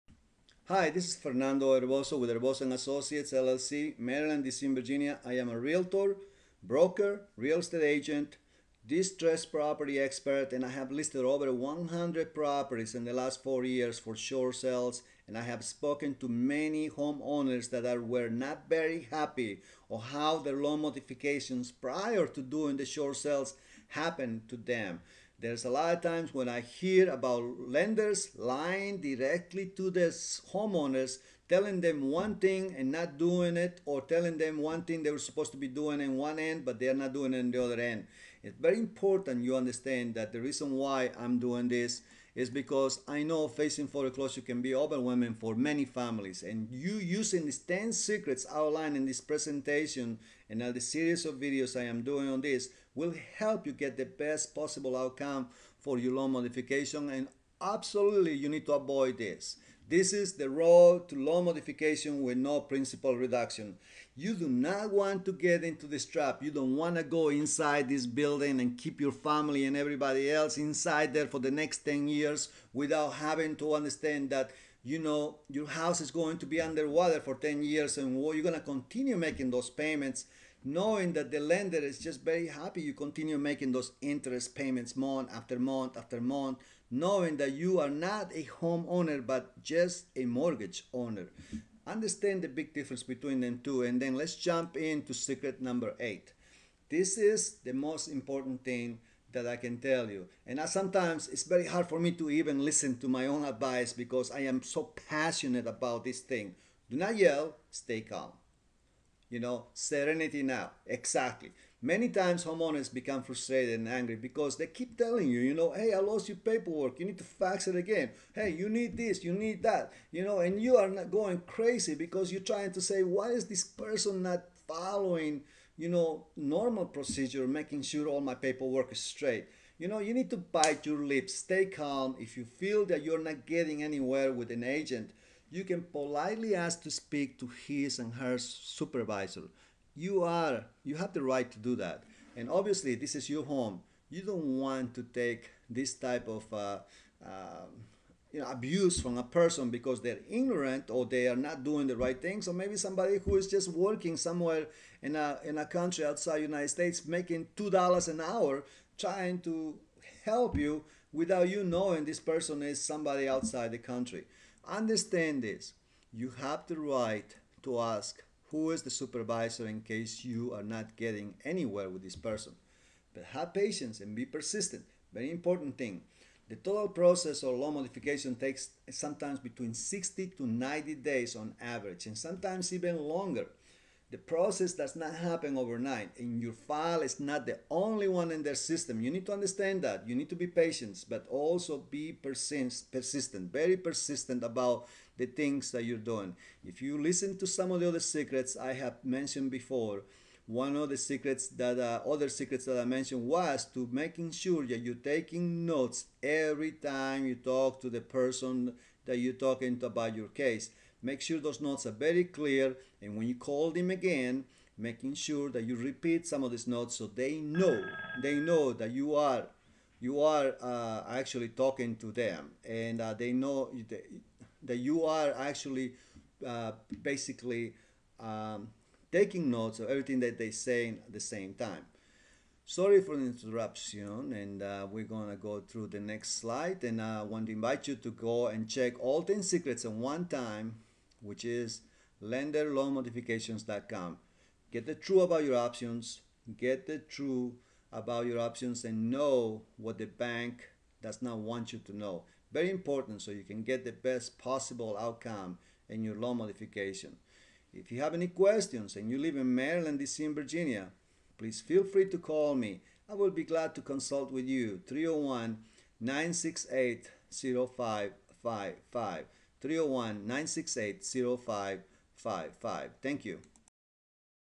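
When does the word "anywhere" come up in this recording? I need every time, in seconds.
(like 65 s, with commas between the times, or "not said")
133 s, 171 s.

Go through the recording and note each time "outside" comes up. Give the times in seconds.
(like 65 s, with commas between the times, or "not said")
156 s, 163 s.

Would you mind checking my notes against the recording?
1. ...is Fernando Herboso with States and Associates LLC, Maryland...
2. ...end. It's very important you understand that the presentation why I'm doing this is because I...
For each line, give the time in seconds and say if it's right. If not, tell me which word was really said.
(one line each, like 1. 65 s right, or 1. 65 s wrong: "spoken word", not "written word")
1. 1 s wrong: "Herboso", not "States"
2. 37 s wrong: "reason", not "presentation".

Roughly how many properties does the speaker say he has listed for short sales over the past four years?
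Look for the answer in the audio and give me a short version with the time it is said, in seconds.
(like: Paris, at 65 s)
over 100, at 11 s.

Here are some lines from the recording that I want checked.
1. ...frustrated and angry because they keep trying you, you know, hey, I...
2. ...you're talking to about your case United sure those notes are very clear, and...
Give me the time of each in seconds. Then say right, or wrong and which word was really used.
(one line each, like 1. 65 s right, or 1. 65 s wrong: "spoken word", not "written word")
1. 113 s wrong: "telling", not "trying"
2. 209 s wrong: "Make", not "United".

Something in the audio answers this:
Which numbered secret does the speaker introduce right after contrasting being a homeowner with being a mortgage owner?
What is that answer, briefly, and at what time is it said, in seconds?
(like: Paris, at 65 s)
8, at 95 s.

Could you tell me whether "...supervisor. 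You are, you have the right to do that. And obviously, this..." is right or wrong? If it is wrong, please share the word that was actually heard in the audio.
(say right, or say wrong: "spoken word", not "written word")
right.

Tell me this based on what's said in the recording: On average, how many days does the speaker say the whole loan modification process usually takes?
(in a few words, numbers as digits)
60 to 90 days.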